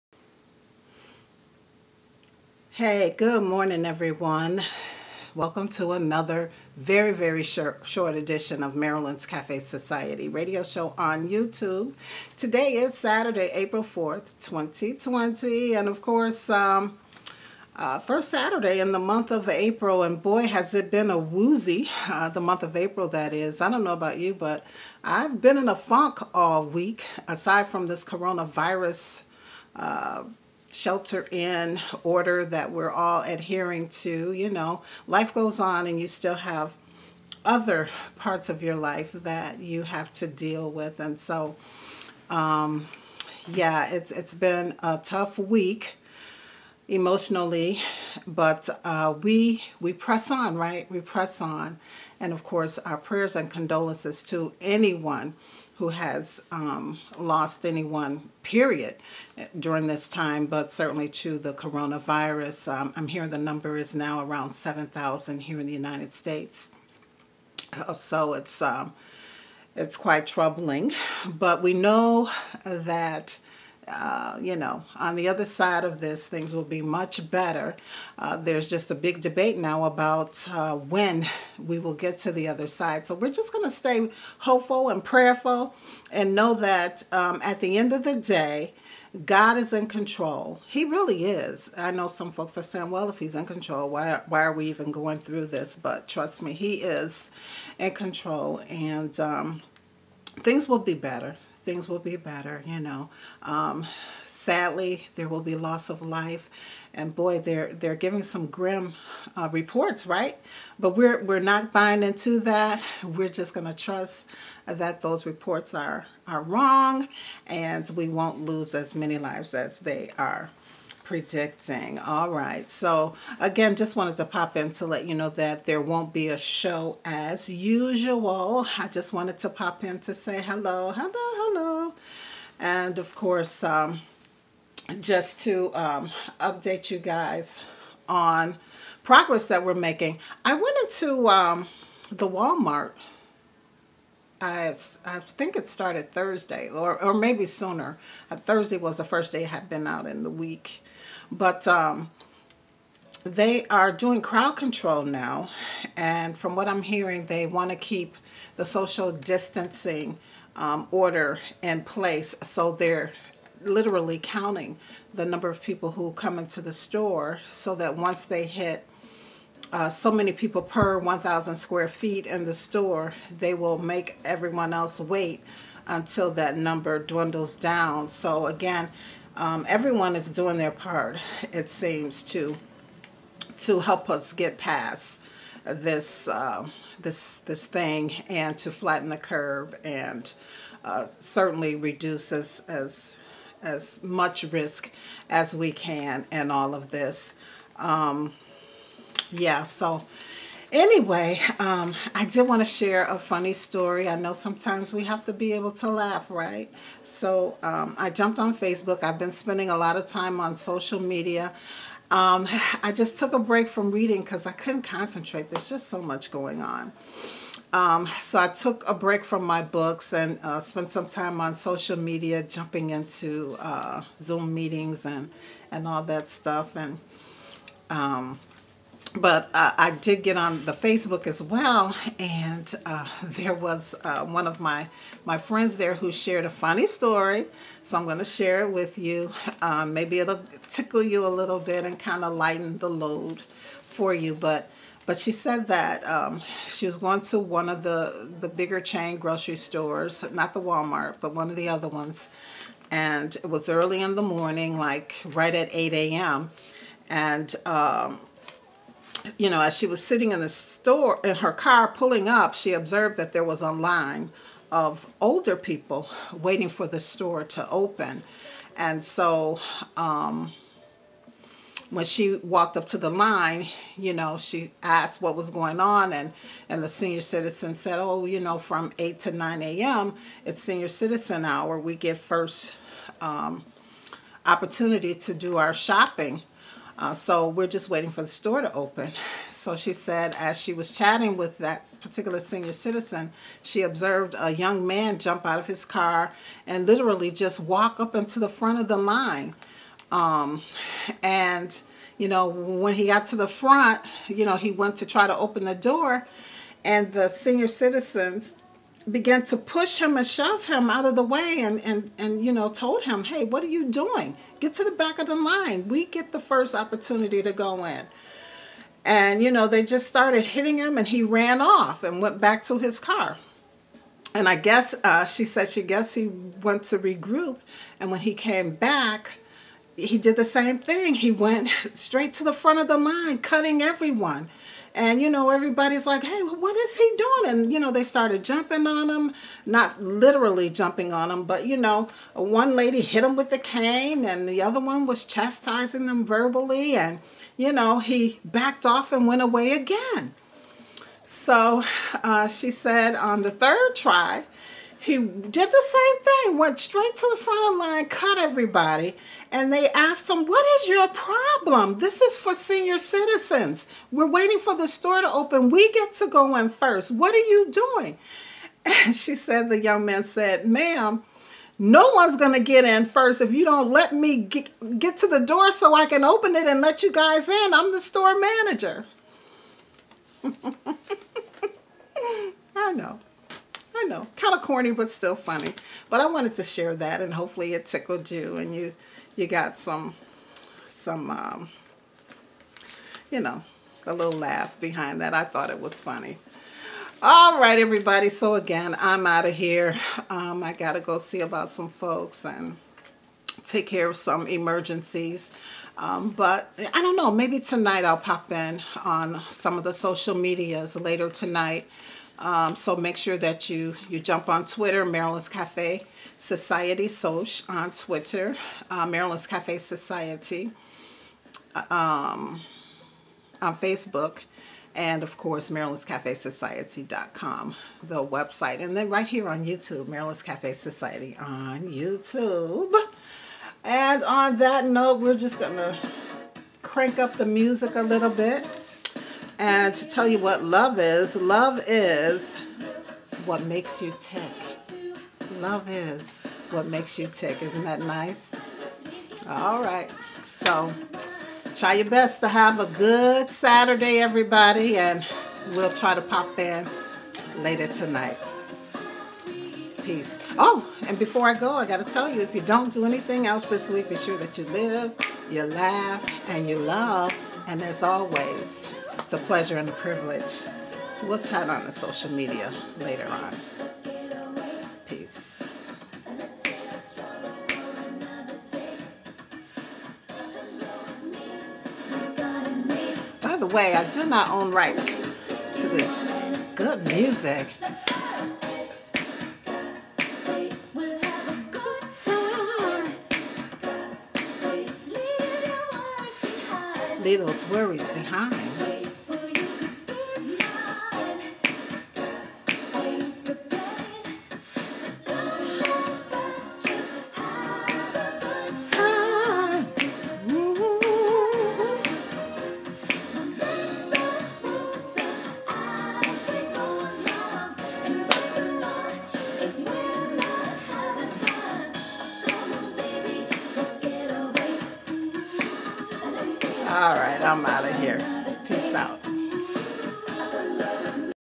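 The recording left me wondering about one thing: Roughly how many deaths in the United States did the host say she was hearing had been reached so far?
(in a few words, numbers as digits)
7,000.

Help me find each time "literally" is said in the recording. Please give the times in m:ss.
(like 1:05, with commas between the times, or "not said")
2:43, 4:56, 5:40.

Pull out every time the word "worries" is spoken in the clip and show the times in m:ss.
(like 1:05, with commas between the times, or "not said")
8:17.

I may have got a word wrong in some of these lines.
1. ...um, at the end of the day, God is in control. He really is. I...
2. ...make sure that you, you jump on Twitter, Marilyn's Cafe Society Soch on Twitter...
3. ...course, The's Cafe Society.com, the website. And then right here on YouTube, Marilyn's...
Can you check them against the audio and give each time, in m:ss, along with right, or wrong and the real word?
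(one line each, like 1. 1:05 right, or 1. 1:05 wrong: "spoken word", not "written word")
1. 1:27 right
2. 6:52 right
3. 7:05 wrong: "Marilyn", not "The".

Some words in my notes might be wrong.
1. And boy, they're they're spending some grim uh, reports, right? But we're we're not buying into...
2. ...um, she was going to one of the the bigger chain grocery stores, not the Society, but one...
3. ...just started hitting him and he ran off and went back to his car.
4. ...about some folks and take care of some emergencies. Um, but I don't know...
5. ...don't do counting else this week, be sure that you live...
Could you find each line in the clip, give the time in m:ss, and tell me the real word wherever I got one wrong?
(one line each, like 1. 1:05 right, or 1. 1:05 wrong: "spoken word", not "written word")
1. 1:46 wrong: "giving", not "spending"
2. 4:06 wrong: "Walmart", not "Society"
3. 5:19 right
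4. 6:41 right
5. 7:42 wrong: "anything", not "counting".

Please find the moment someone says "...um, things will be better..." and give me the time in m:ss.
1:39.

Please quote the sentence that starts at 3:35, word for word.
There's just so much going on.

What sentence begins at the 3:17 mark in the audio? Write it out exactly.
Um, yeah, so Anyway, um, I did want to share a funny story.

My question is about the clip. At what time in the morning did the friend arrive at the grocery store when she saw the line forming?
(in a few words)
8 a.m.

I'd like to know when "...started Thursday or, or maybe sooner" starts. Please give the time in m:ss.
2:25.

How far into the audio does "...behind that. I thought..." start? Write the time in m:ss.
6:34.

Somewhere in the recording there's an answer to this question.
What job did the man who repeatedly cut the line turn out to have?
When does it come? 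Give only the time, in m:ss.
6:18.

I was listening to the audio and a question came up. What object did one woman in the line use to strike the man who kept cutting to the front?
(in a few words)
cane.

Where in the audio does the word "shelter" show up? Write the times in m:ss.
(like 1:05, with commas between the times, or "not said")
0:30.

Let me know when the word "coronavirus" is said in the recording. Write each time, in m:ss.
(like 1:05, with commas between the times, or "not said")
0:28, 1:01.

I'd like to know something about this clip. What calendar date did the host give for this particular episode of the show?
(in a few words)
April 4th, 2020.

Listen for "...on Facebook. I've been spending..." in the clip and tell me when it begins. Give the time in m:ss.
3:28.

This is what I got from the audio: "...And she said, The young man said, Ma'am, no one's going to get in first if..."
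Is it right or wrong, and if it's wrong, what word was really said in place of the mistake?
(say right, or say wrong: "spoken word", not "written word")
right.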